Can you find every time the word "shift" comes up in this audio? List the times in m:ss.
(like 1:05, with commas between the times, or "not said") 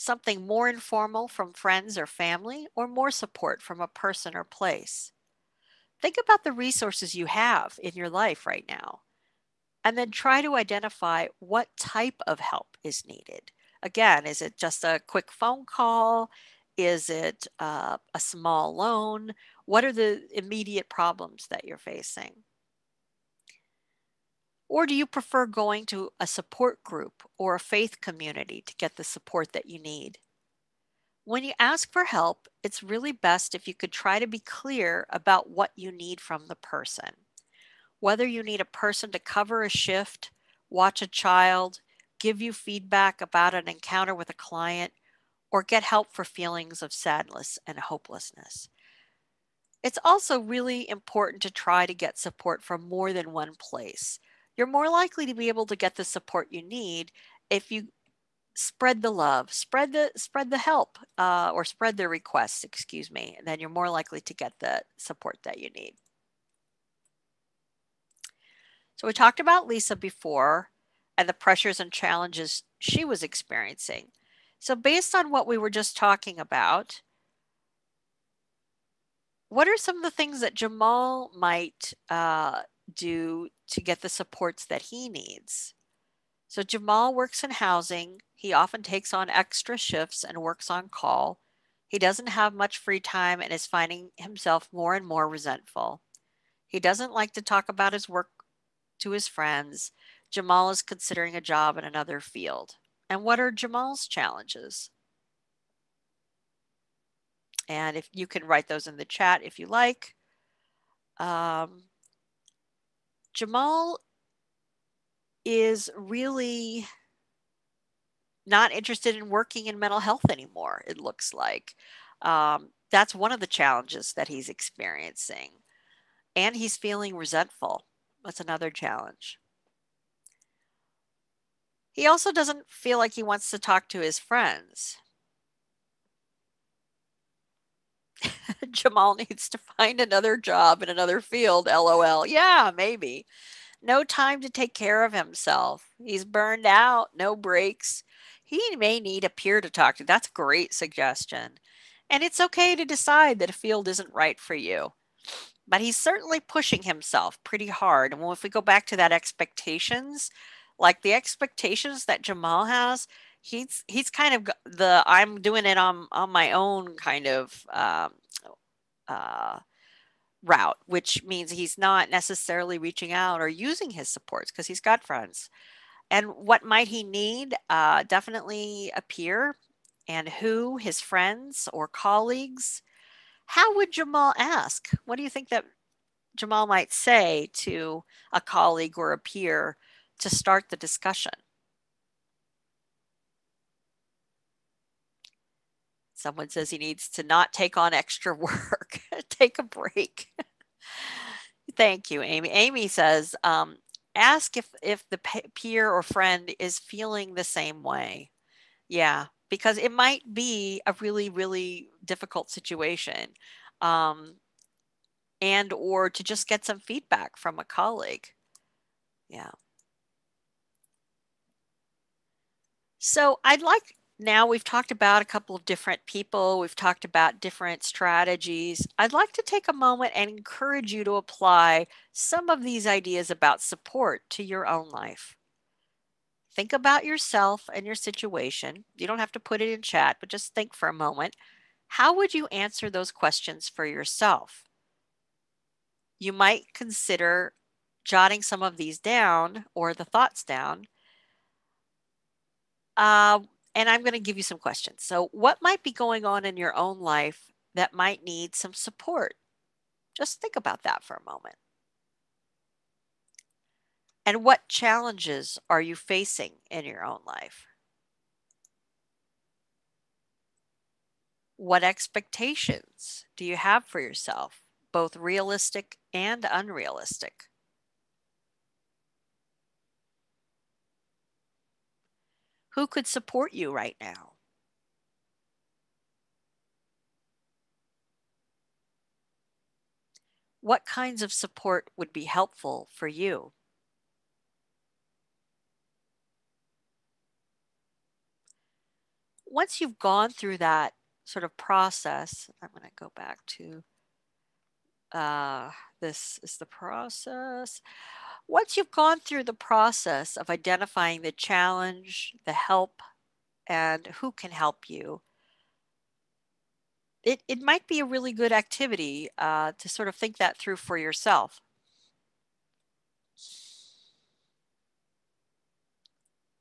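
0:39, 1:29.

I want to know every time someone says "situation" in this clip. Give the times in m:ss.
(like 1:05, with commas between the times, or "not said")
3:32, 3:57.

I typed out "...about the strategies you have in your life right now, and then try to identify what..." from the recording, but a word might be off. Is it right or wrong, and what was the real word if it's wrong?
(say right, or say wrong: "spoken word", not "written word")
wrong: "resources", not "strategies".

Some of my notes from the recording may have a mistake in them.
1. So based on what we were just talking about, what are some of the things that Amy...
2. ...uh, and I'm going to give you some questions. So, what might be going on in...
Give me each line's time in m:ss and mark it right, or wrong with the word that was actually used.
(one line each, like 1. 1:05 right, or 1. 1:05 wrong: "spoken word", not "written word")
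1. 1:14 wrong: "Jamal", not "Amy"
2. 4:12 right.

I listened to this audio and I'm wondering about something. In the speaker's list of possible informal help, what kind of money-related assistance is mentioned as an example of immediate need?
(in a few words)
A small loan.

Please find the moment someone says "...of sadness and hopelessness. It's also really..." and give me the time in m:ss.
0:46.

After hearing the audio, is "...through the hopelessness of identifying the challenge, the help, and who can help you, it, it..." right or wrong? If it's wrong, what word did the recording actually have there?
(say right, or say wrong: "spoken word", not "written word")
wrong: "process", not "hopelessness".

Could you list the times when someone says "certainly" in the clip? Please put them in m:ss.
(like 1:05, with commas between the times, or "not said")
2:35.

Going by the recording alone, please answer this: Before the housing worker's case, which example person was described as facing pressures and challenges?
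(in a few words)
Lisa.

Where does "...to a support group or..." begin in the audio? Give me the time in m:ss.
0:25.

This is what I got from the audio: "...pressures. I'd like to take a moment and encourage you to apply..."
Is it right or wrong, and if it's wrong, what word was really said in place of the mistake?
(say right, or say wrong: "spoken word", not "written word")
wrong: "strategies", not "pressures".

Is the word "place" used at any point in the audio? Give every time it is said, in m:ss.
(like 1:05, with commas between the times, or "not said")
0:04, 0:53.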